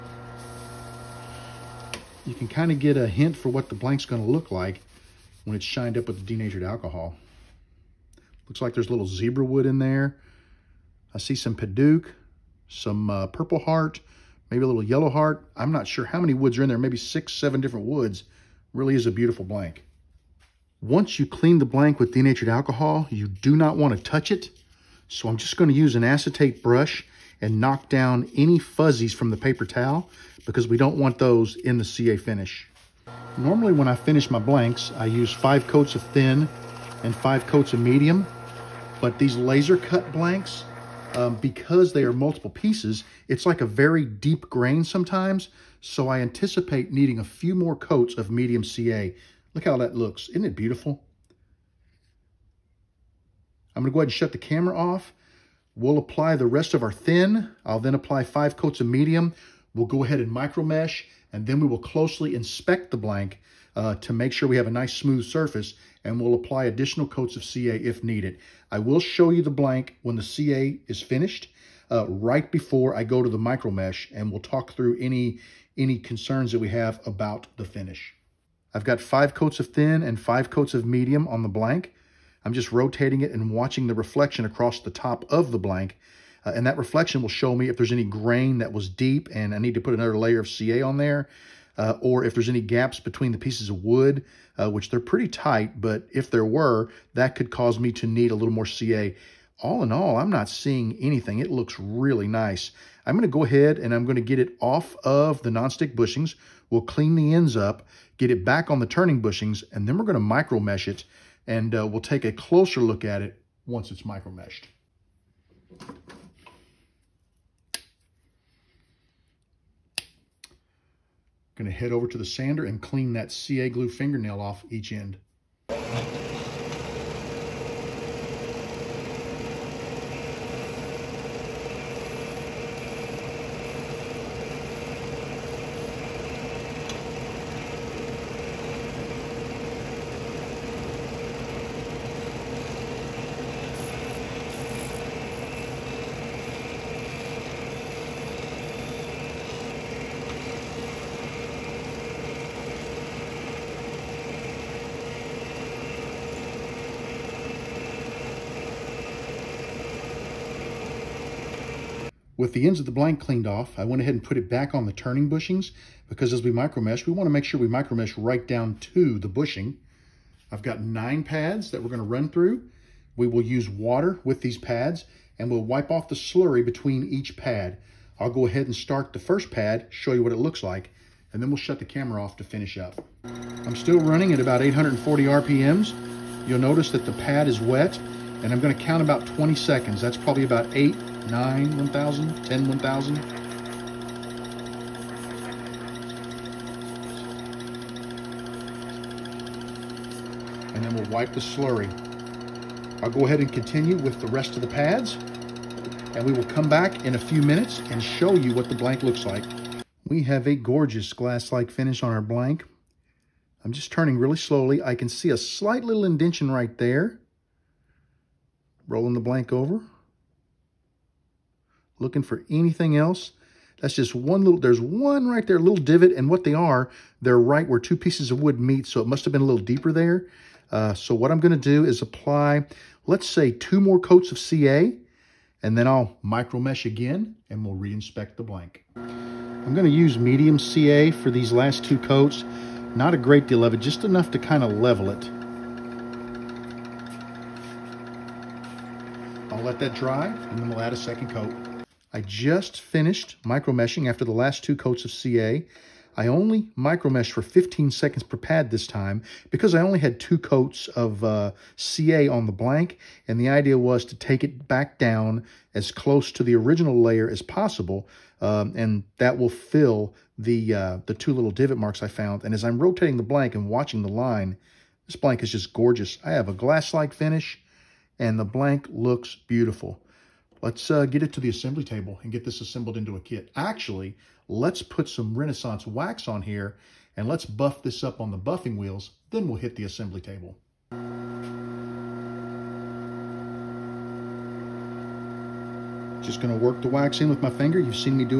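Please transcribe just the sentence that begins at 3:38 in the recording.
Rolling the blank over looking for anything else.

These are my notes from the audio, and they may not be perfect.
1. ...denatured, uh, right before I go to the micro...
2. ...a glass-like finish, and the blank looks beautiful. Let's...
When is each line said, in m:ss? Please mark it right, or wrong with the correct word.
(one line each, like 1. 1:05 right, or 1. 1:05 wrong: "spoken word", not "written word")
1. 1:11 wrong: "finished", not "denatured"
2. 4:36 right.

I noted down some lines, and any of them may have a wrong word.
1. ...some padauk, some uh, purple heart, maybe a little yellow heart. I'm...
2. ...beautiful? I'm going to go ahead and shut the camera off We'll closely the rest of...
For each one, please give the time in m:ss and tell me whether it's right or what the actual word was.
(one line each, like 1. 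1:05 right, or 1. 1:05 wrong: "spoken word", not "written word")
1. 0:11 right
2. 0:50 wrong: "apply", not "closely".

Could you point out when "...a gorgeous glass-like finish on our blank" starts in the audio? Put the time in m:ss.
3:30.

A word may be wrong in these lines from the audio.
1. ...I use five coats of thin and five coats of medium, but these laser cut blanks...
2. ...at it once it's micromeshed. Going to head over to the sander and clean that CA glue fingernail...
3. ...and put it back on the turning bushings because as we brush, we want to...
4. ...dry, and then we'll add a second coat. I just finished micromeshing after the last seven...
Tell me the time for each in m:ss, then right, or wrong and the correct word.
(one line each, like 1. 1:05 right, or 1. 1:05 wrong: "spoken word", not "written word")
1. 0:34 right
2. 1:53 right
3. 2:44 wrong: "micromesh", not "brush"
4. 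4:09 wrong: "two", not "seven".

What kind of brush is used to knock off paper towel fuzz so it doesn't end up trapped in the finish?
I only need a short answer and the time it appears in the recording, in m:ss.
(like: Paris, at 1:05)
acetate brush, at 0:26.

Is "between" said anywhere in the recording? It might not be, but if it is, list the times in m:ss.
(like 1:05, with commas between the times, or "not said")
1:33, 2:56.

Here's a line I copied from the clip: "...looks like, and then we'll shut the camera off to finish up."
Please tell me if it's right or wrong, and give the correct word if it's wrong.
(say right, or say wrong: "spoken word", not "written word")
right.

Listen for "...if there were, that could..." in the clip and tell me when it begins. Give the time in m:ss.
1:36.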